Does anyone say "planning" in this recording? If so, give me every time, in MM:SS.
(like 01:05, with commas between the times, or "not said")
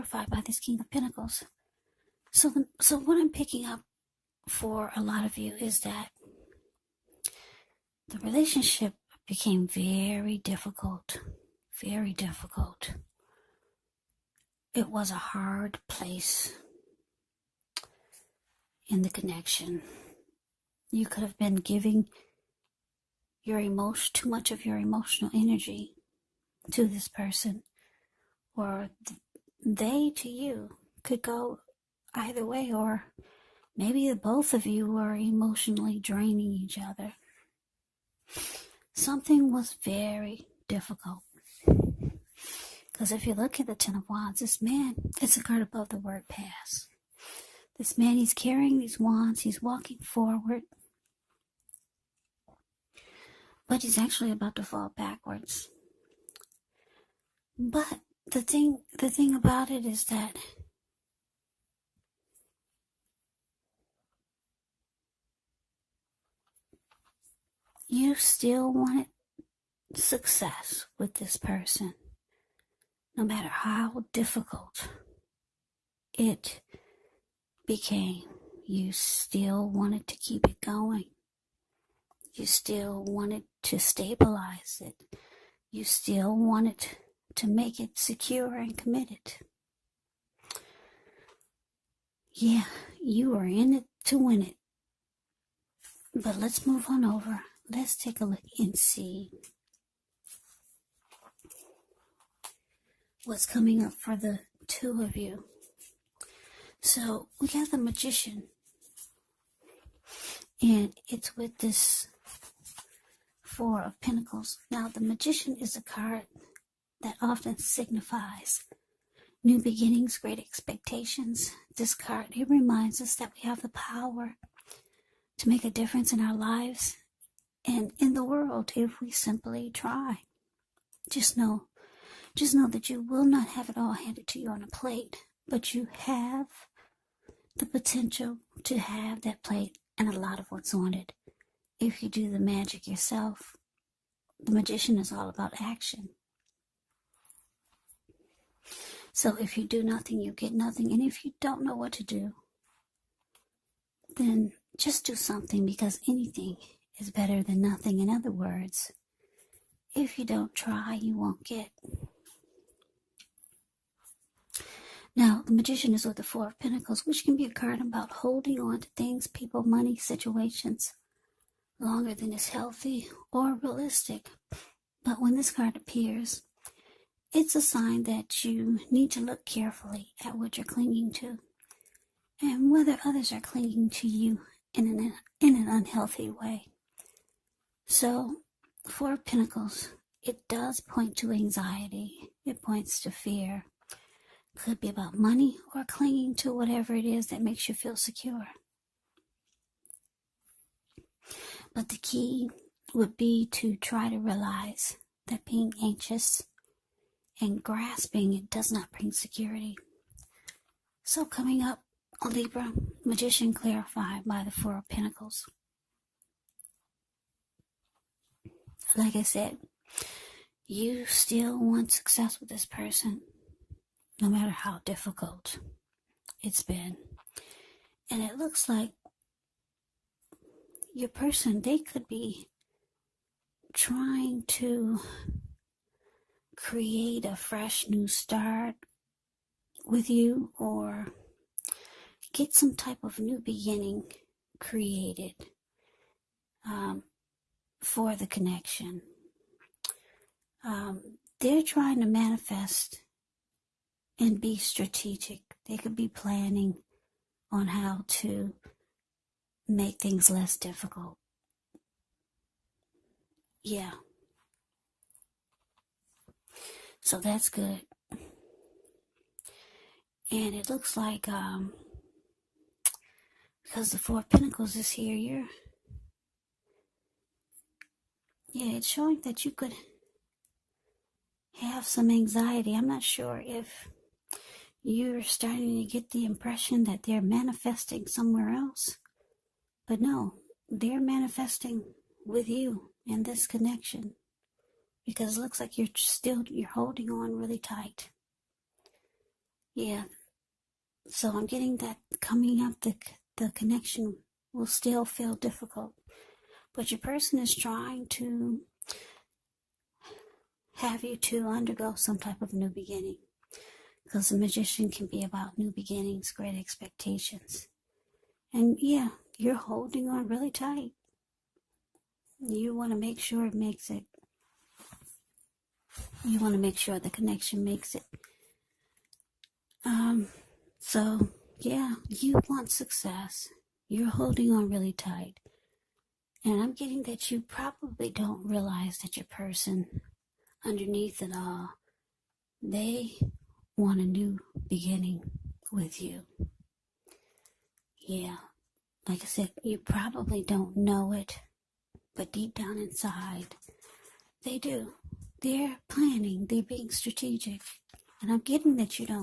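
04:16, 05:55.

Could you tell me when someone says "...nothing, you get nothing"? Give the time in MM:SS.
02:29.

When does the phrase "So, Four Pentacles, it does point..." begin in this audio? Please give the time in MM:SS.
03:07.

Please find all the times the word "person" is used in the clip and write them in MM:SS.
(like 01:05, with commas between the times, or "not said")
00:27, 01:11, 03:42, 03:51, 05:06, 05:39.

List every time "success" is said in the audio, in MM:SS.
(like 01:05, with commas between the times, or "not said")
01:09, 03:41, 05:32.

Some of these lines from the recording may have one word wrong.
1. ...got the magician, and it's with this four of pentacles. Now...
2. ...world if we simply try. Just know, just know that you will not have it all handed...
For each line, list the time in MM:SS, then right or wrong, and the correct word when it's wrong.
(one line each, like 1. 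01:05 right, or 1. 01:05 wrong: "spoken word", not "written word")
1. 01:47 right
2. 02:08 right.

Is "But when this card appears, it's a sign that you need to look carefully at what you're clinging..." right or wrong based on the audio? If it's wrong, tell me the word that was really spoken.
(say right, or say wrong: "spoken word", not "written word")
right.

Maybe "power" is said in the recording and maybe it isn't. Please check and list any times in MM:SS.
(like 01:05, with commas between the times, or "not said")
02:03.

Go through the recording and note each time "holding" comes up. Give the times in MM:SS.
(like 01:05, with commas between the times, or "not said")
02:48, 04:56, 05:19, 05:34.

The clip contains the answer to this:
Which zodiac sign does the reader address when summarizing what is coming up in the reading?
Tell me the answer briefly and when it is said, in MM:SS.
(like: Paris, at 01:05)
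Libra, at 03:32.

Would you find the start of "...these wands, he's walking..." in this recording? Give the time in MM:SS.
00:48.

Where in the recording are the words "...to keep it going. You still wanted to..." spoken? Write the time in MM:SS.
01:20.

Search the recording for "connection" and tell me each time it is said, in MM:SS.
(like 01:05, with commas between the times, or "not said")
00:19, 04:08, 04:53, 05:03, 05:27.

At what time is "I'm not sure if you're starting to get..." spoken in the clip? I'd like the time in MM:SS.
04:42.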